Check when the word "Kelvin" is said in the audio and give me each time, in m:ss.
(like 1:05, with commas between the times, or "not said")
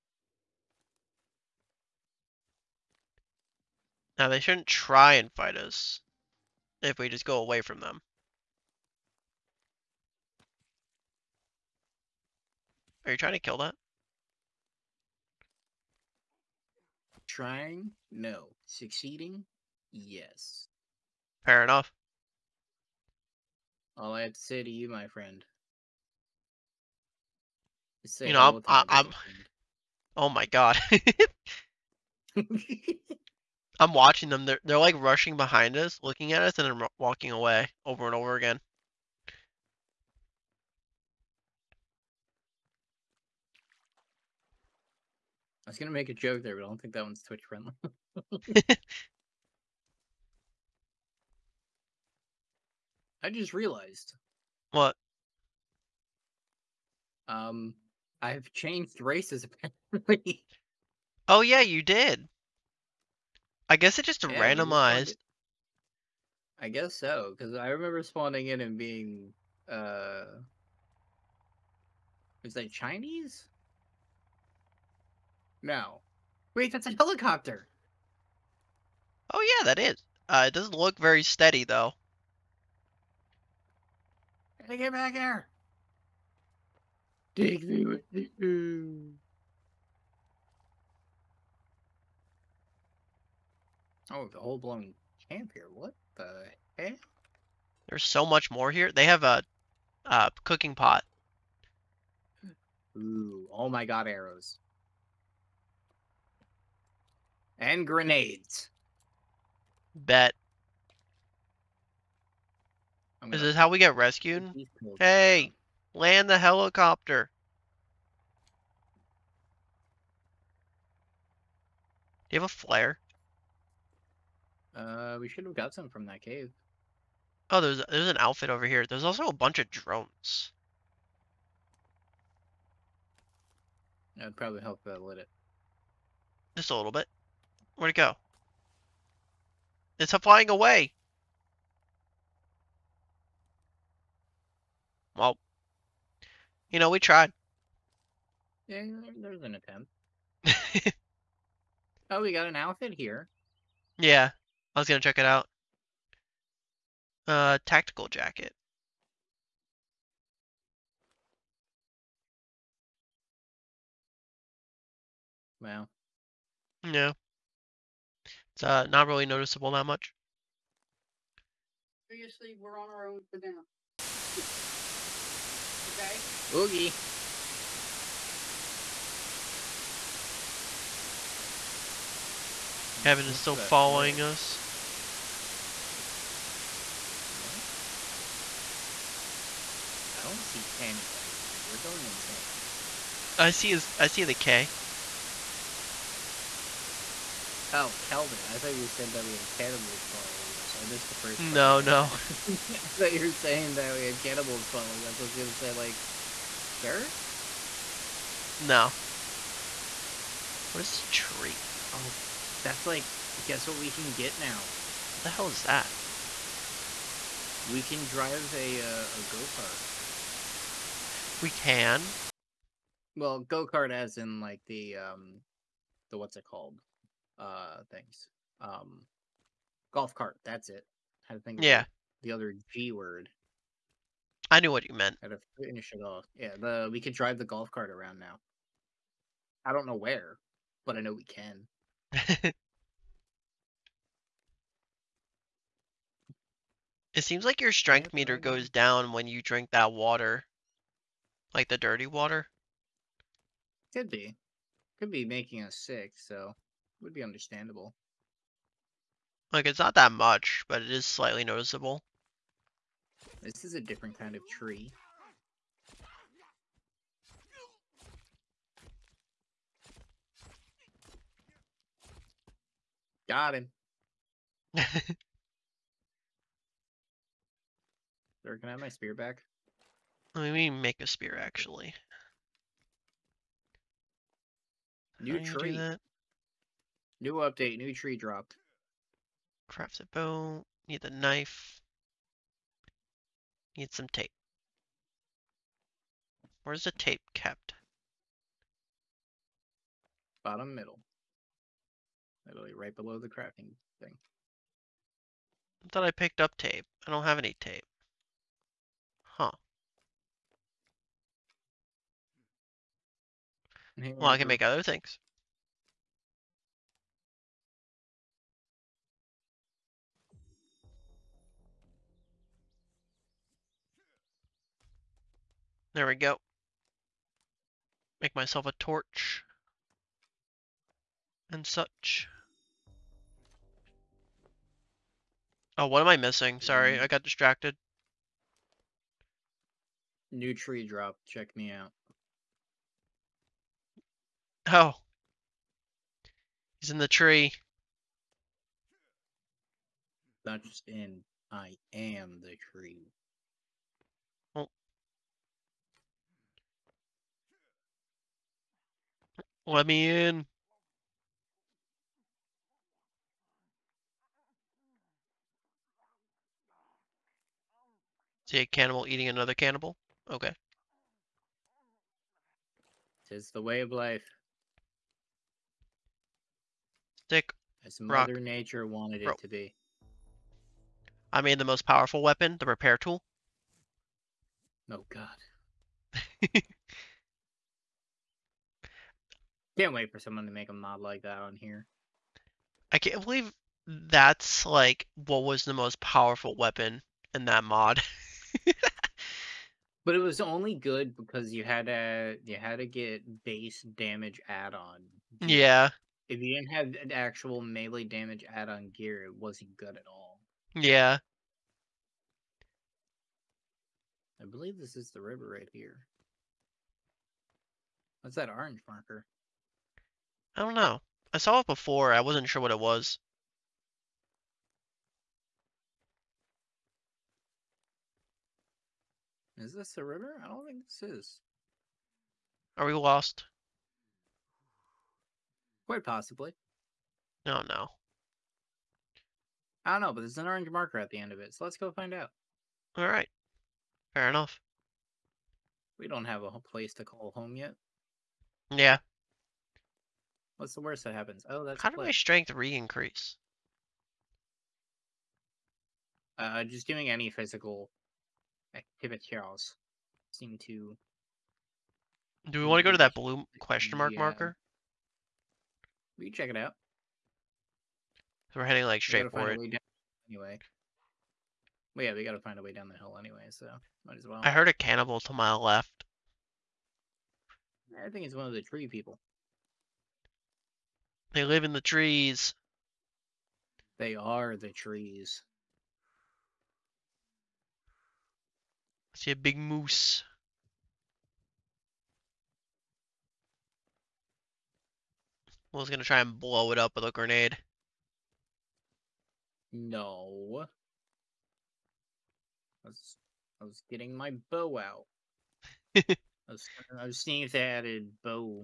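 3:03, 3:18.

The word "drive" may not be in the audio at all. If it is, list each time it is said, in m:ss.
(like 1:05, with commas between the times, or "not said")
3:38, 3:57.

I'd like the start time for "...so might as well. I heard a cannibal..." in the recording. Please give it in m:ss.
7:53.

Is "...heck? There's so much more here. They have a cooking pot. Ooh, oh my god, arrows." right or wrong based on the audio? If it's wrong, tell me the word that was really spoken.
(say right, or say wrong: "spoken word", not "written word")
right.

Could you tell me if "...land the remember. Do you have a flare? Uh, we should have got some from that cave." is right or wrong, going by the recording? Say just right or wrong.
wrong.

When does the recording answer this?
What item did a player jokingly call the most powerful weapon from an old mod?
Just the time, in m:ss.
6:22.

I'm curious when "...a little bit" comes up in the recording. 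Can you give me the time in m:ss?
2:16.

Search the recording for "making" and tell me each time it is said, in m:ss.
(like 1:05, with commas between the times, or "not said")
4:15.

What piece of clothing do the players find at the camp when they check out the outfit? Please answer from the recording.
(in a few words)
Tactical jacket.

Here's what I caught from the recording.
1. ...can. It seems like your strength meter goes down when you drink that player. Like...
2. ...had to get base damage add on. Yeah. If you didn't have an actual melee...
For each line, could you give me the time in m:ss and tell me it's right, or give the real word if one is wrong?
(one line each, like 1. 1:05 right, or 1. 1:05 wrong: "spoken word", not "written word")
1. 4:01 wrong: "water", not "player"
2. 6:42 right.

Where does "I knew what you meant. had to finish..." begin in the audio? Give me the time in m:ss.
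3:54.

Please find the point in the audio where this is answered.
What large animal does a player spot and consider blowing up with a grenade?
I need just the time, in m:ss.
8:09.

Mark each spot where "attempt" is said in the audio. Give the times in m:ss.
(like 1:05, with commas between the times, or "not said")
2:29.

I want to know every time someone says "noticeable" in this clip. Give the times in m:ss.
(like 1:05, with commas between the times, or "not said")
2:49, 4:21.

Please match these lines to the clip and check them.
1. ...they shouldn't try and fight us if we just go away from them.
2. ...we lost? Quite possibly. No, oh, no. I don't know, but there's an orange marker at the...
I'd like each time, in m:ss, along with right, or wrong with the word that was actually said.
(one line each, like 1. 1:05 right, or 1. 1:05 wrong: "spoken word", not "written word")
1. 0:04 right
2. 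7:12 right.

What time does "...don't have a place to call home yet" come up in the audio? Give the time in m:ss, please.
7:26.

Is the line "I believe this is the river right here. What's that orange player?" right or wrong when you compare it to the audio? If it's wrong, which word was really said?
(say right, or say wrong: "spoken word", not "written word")
wrong: "marker", not "player".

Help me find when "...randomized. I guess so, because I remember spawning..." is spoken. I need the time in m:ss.
1:04.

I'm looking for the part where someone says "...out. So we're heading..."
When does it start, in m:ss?
7:46.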